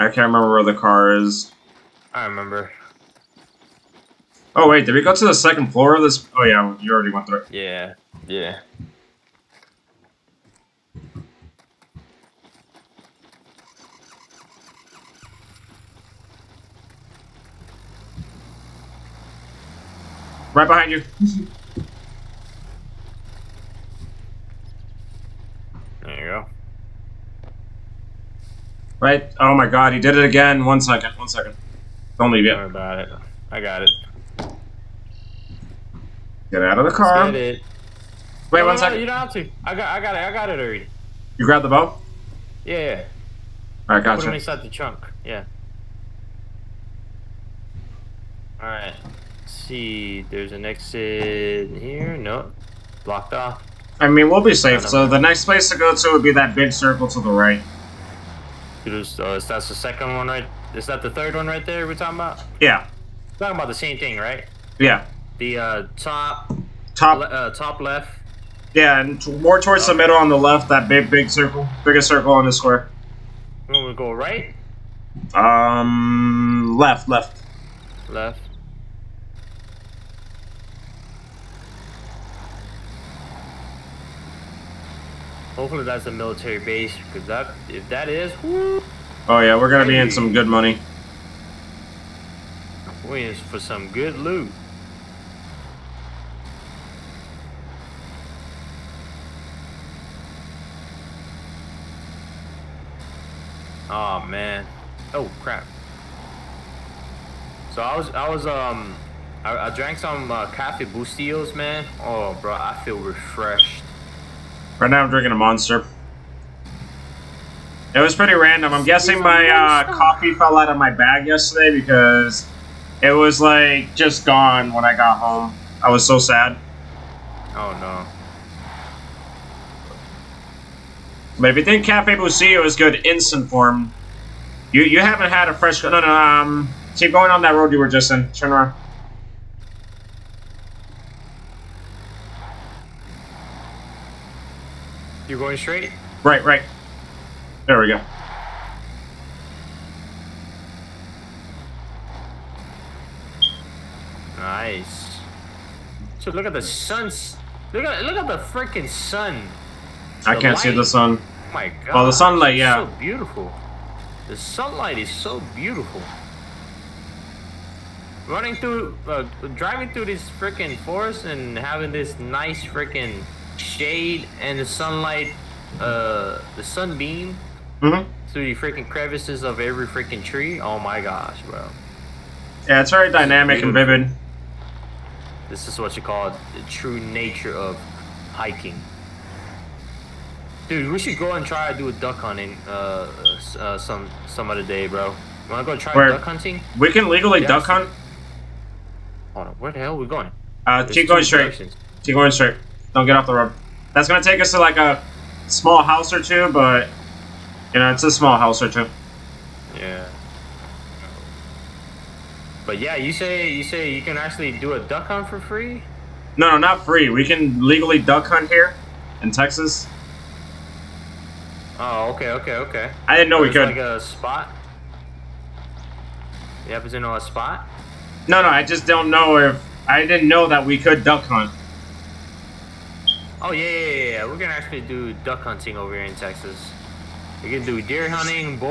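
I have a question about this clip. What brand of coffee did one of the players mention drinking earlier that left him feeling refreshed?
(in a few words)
Cafe Bustelo.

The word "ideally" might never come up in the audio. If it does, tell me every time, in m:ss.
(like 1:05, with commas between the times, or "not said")
not said.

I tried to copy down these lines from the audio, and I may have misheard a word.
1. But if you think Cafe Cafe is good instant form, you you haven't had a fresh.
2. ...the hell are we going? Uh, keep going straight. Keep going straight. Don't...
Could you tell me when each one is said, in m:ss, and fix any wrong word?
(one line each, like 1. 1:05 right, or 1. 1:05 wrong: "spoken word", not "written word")
1. 2:11 wrong: "Bustelo", not "Cafe"
2. 3:19 right.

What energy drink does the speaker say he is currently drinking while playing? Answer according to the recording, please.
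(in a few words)
Monster.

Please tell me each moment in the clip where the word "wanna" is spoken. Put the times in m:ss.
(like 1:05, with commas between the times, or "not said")
3:15.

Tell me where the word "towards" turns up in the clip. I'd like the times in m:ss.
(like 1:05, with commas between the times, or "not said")
1:09.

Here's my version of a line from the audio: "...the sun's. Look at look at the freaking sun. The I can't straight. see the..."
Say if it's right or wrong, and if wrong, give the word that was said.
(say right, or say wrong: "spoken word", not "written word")
wrong: "light", not "straight".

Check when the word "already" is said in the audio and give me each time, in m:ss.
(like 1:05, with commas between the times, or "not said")
0:06, 0:40.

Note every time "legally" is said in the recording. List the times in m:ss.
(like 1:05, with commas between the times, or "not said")
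3:17, 3:37.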